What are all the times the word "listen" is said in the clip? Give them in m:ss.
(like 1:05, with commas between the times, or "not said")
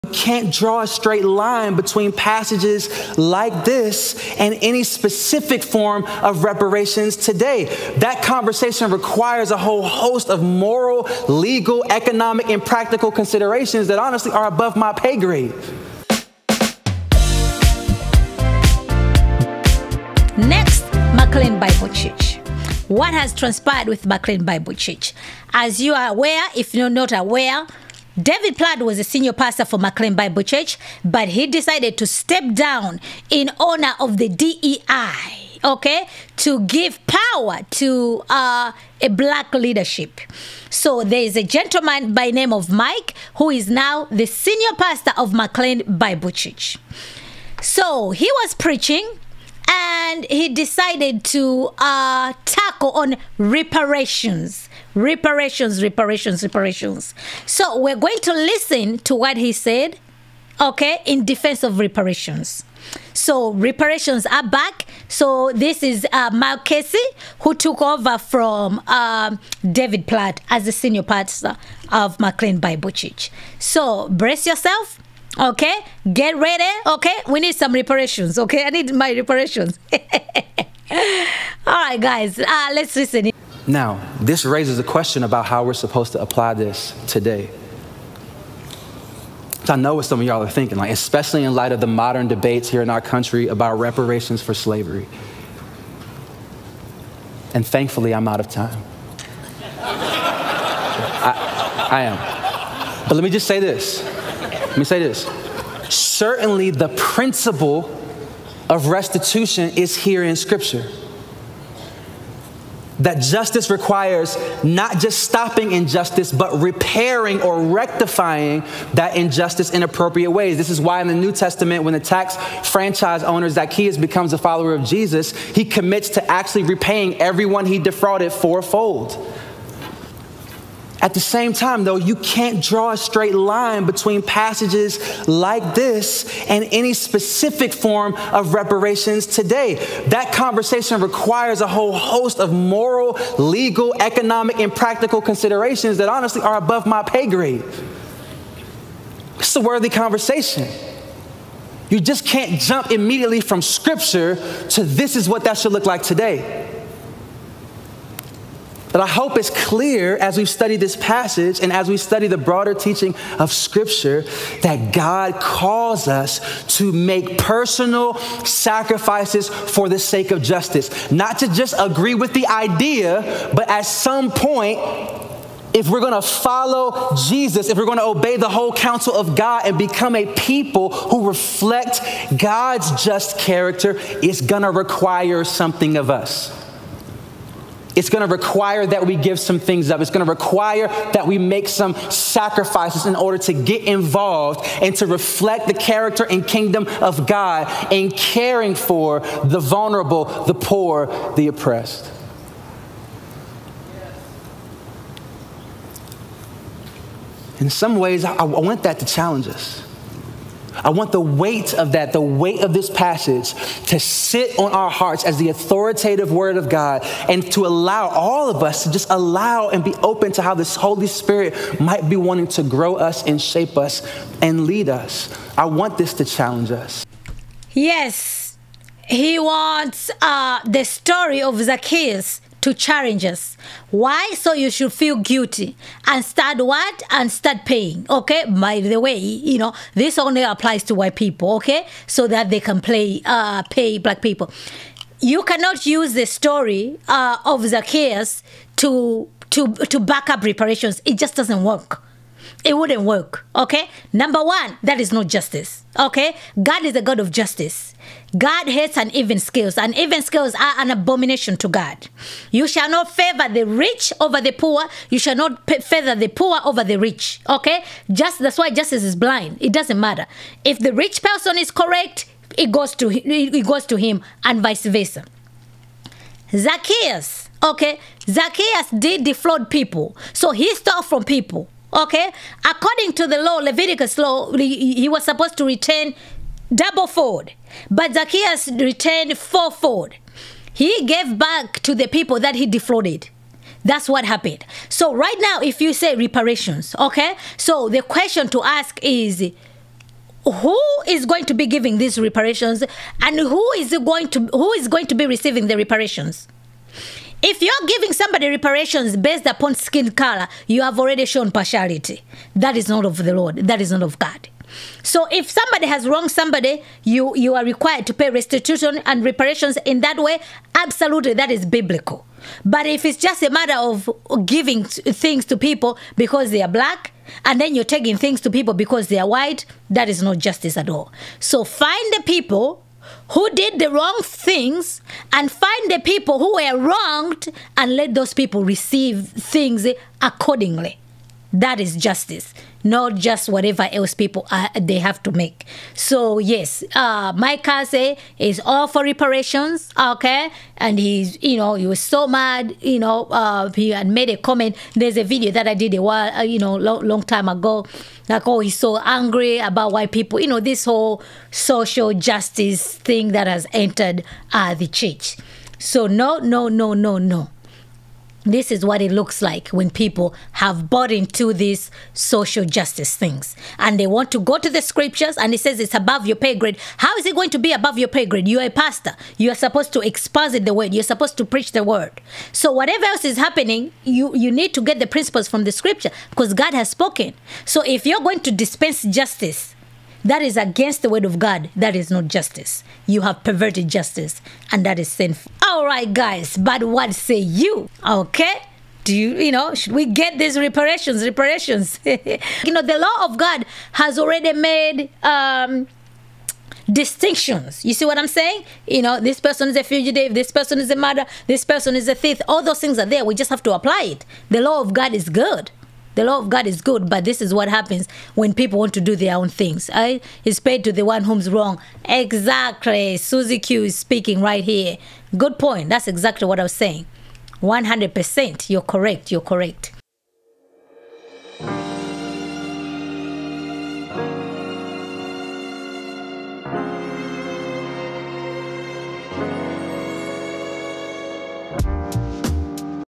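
0:58, 1:22.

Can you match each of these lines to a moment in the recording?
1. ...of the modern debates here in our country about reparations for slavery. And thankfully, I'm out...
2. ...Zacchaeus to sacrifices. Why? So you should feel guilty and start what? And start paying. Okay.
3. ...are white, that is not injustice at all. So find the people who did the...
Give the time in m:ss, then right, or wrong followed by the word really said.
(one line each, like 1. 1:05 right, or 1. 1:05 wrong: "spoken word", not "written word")
1. 1:31 right
2. 3:51 wrong: "challenges", not "sacrifices"
3. 5:29 wrong: "justice", not "injustice".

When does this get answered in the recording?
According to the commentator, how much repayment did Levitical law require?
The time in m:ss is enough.
4:46.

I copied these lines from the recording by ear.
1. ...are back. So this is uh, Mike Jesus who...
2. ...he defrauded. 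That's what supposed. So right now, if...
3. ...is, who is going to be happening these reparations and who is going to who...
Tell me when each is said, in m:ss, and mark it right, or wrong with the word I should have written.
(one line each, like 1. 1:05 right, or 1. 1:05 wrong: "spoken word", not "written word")
1. 1:04 wrong: "Kelsey", not "Jesus"
2. 4:52 wrong: "happened", not "supposed"
3. 4:59 wrong: "giving", not "happening".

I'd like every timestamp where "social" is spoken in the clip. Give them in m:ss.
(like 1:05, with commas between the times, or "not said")
6:01, 6:12.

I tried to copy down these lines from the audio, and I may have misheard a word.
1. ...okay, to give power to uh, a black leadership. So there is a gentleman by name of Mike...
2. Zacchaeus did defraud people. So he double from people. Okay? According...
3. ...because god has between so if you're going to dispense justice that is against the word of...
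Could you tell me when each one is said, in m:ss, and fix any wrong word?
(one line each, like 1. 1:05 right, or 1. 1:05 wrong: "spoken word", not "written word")
1. 0:35 right
2. 4:38 wrong: "stole", not "double"
3. 6:26 wrong: "spoken", not "between".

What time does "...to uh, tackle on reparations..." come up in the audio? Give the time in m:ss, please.
0:51.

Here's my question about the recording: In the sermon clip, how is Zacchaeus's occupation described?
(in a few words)
tax franchise owner.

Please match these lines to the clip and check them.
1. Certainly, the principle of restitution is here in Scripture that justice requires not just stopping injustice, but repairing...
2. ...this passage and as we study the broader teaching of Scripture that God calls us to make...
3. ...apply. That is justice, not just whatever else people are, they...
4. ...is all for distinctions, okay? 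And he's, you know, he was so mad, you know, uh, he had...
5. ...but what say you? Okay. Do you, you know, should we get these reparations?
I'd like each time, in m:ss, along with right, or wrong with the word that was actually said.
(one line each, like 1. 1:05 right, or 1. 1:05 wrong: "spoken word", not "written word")
1. 1:45 right
2. 2:40 right
3. 5:40 wrong: "accordingly", not "apply"
4. 5:48 wrong: "reparations", not "distinctions"
5. 6:36 right.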